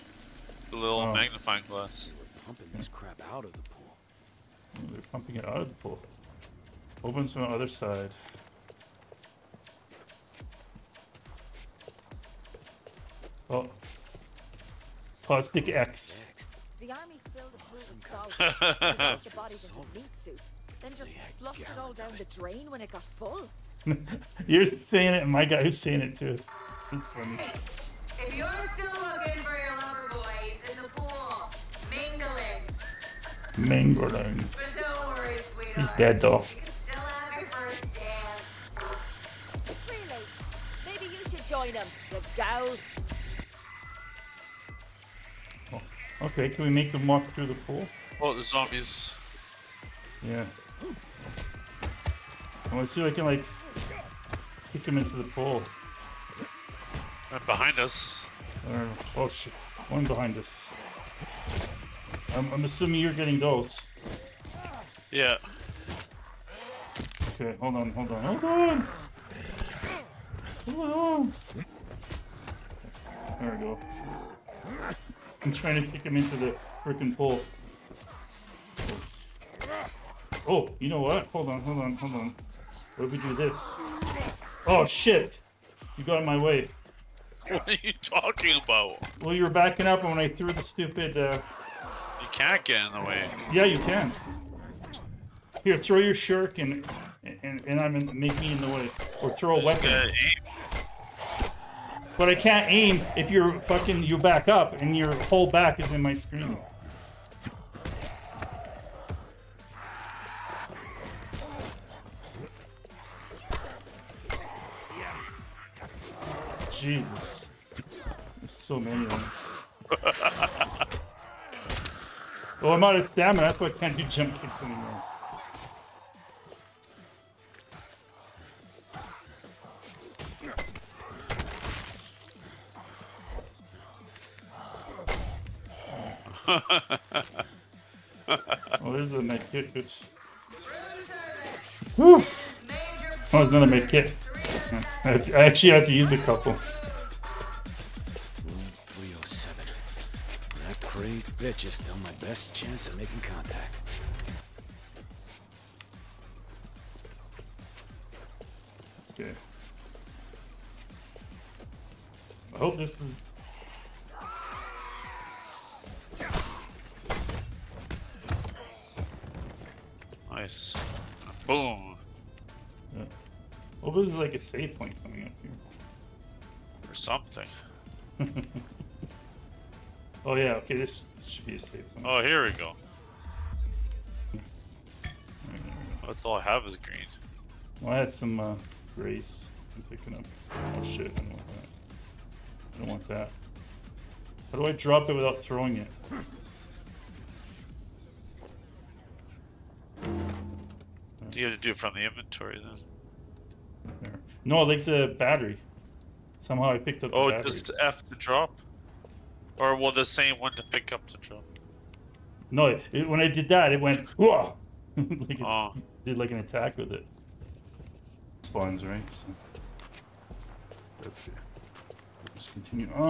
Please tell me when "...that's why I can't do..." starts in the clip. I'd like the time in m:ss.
2:03.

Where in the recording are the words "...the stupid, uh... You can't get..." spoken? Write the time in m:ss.
1:30.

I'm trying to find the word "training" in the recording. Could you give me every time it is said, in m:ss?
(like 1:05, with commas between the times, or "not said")
not said.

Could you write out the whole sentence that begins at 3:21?
you have to do it from the inventory then.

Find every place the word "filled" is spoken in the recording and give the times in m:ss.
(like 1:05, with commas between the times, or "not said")
0:17.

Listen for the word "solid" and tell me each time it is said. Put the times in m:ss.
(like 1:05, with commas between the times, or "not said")
0:17.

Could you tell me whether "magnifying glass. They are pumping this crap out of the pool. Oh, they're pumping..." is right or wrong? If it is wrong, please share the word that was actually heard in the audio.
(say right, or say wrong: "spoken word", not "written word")
right.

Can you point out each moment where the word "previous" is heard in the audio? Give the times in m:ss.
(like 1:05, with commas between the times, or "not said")
not said.